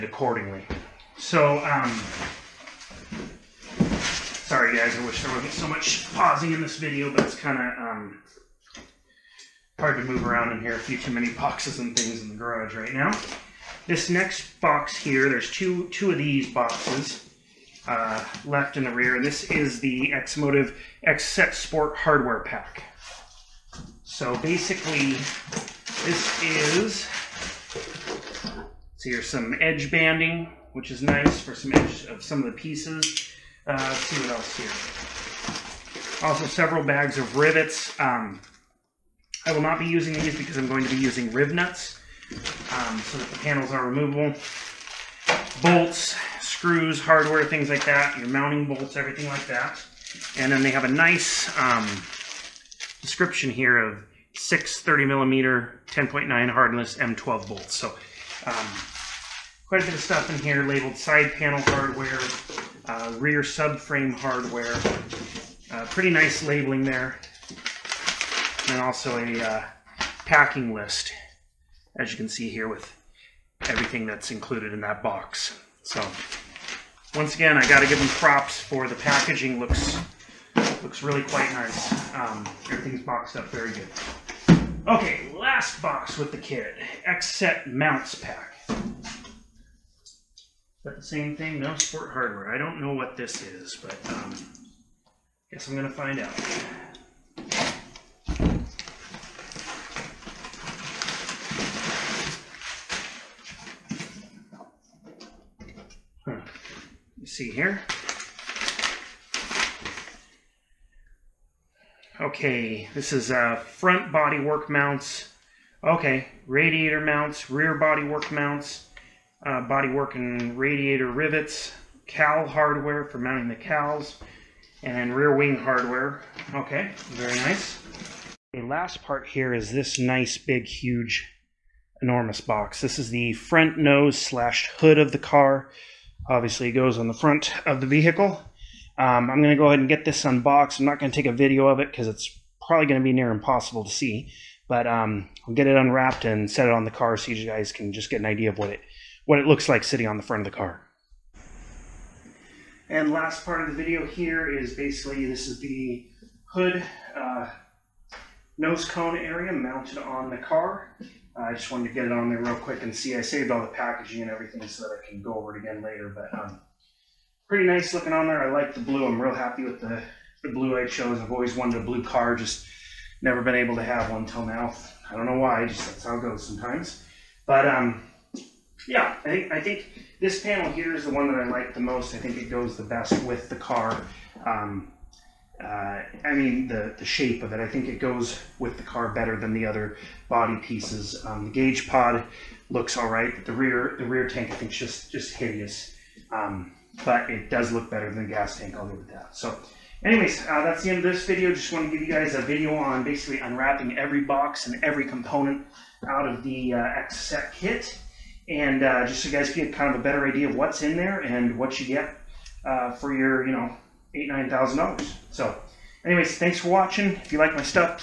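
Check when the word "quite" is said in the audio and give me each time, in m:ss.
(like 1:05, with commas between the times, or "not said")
0:59, 1:21.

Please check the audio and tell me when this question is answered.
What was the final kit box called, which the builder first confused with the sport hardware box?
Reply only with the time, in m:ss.
1:27.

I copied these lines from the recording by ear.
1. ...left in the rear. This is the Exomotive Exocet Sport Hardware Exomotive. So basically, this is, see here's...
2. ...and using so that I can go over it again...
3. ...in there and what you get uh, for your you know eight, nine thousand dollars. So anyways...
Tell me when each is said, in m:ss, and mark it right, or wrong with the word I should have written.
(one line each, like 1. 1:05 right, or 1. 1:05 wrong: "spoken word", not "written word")
1. 0:18 wrong: "Pack", not "Exomotive"
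2. 2:44 wrong: "everything", not "using"
3. 3:30 right.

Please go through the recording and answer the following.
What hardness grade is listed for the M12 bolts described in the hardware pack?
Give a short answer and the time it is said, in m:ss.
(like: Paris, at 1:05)
10.9, at 0:55.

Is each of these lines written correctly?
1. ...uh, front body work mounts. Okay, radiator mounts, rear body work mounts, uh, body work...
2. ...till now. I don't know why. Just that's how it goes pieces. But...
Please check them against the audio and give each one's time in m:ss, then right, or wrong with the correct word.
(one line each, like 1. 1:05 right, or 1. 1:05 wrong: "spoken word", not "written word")
1. 1:53 right
2. 2:54 wrong: "sometimes", not "pieces".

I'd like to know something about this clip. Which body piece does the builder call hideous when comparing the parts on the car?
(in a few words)
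rear tank.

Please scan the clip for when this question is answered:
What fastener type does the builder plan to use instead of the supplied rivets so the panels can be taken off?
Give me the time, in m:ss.
0:41.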